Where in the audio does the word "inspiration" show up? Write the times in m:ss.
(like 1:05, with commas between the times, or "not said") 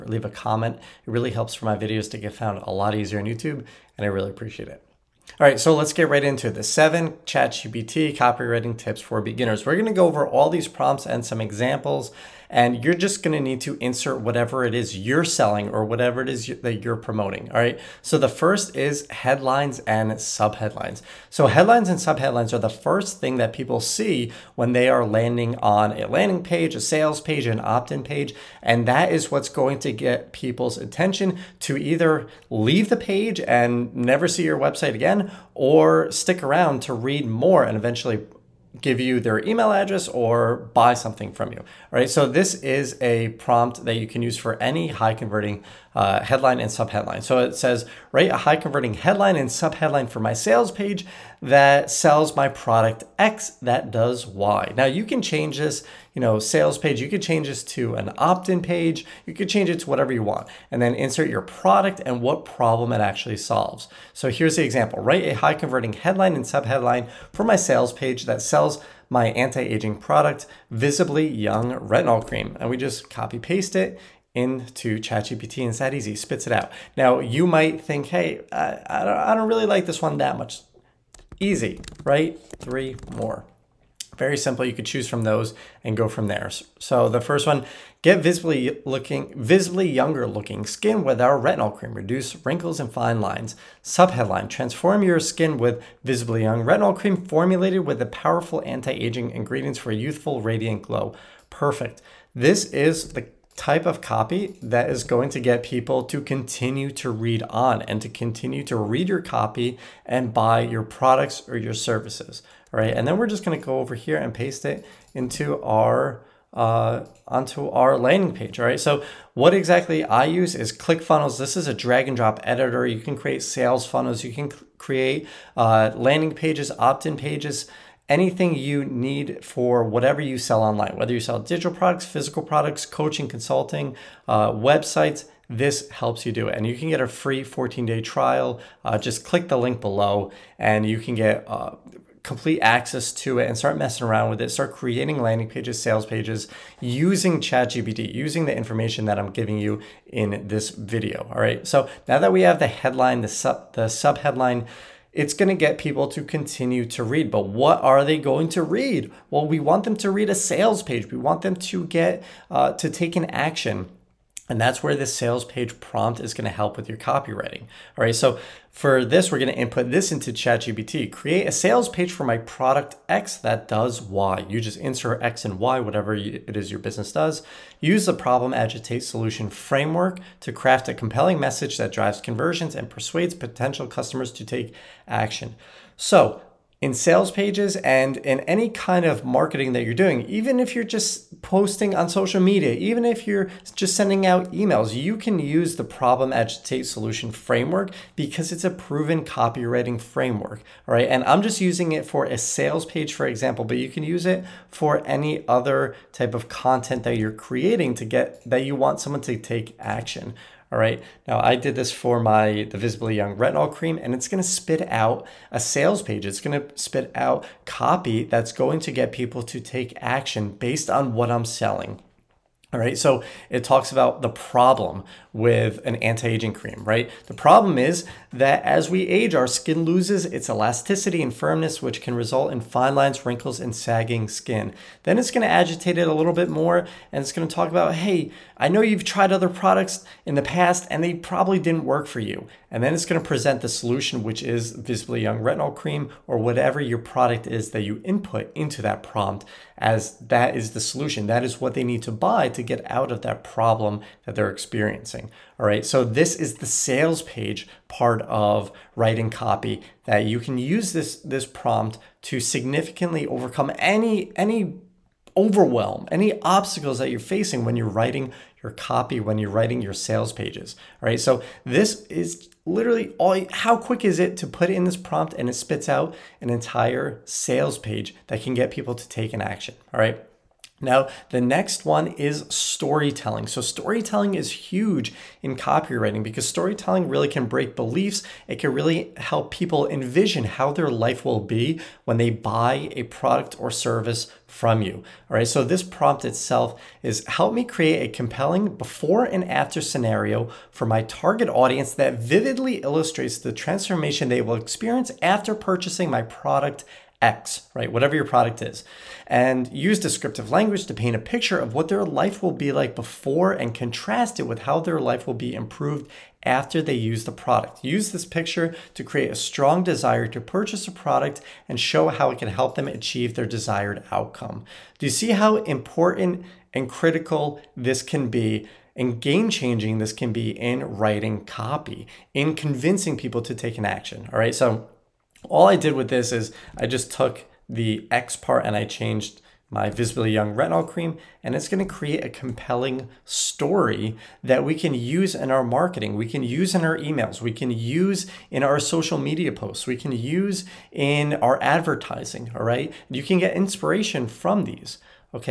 5:53.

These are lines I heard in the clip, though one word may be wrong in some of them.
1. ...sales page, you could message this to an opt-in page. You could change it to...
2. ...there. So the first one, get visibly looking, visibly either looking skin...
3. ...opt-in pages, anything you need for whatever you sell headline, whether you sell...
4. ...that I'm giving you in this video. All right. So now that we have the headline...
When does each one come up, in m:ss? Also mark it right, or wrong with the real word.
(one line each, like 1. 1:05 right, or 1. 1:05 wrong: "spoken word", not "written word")
1. 0:56 wrong: "change", not "message"
2. 1:26 wrong: "younger", not "either"
3. 2:06 wrong: "online", not "headline"
4. 2:29 right.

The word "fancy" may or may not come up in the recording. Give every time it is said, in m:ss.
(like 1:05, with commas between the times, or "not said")
not said.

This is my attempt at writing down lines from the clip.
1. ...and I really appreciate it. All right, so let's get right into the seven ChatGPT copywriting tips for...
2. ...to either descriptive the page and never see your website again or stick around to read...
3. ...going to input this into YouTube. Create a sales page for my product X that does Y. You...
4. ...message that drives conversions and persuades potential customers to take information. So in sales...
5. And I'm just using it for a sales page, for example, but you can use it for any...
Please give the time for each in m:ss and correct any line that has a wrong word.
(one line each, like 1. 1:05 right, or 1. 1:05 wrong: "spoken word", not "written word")
1. 0:03 right
2. 0:31 wrong: "leave", not "descriptive"
3. 2:49 wrong: "ChatGPT", not "YouTube"
4. 3:01 wrong: "action", not "information"
5. 3:21 right.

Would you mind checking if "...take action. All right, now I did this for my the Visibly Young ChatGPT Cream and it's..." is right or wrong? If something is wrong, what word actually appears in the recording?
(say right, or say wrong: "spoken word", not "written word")
wrong: "Retinol", not "ChatGPT".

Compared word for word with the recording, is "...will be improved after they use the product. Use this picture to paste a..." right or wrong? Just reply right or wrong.
wrong.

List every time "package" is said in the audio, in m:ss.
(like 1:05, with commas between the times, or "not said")
not said.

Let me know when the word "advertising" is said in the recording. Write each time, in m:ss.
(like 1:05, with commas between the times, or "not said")
5:51.